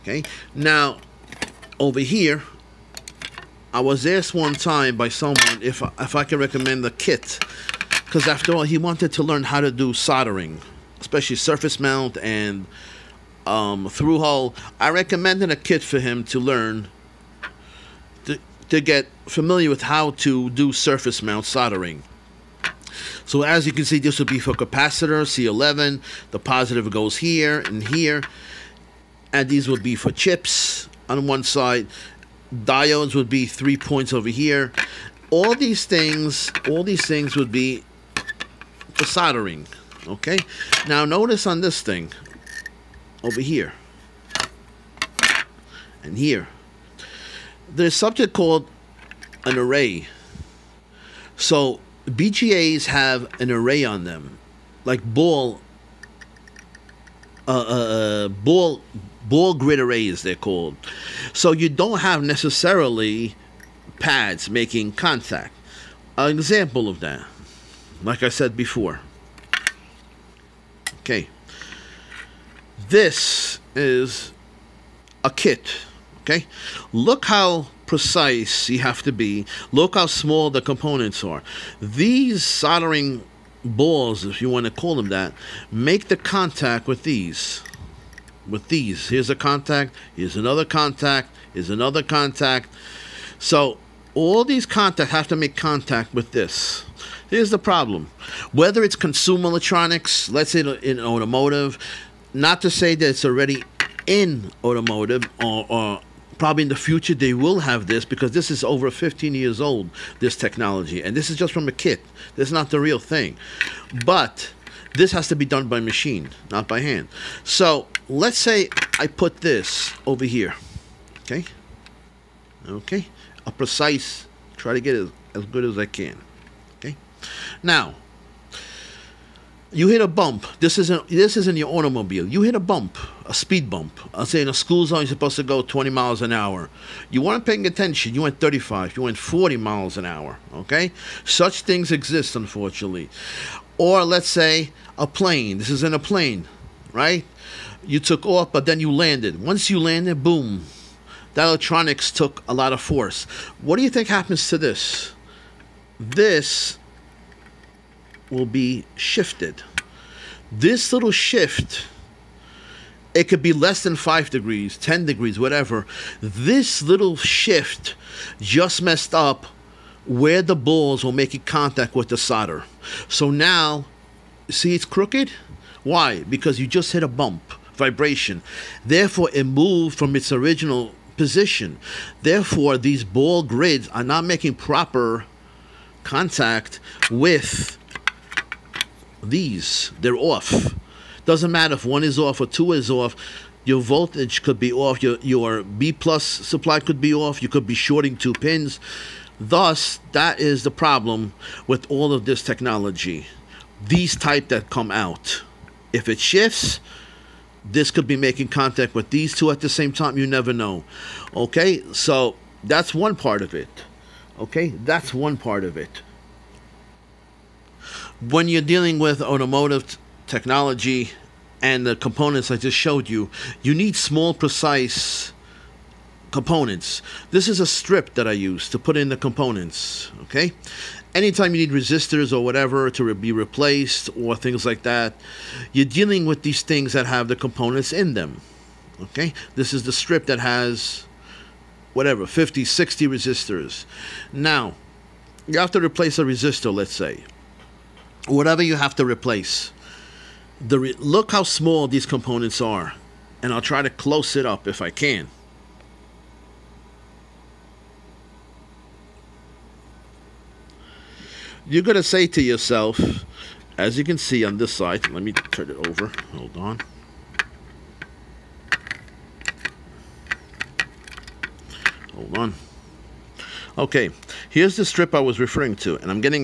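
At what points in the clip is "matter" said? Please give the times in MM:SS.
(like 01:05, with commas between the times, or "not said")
03:11.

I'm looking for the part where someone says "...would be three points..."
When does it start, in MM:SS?
00:33.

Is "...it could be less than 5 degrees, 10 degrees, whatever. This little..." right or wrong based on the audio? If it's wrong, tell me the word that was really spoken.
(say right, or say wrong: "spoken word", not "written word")
right.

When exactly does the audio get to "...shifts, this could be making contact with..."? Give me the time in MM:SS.
03:26.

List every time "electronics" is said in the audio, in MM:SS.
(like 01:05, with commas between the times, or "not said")
01:39, 02:31.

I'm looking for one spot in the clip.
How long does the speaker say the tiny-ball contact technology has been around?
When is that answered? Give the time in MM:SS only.
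01:48.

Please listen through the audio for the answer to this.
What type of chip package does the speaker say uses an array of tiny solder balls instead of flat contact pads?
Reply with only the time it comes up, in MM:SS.
00:59.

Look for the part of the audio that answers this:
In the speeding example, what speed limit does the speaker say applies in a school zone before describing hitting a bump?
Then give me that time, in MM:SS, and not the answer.
02:15.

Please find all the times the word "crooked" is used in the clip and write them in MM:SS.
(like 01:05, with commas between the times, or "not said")
02:54.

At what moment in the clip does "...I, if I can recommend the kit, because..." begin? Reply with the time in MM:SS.
00:05.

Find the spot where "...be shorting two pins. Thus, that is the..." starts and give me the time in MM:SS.
03:17.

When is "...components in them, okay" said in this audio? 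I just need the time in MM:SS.
03:57.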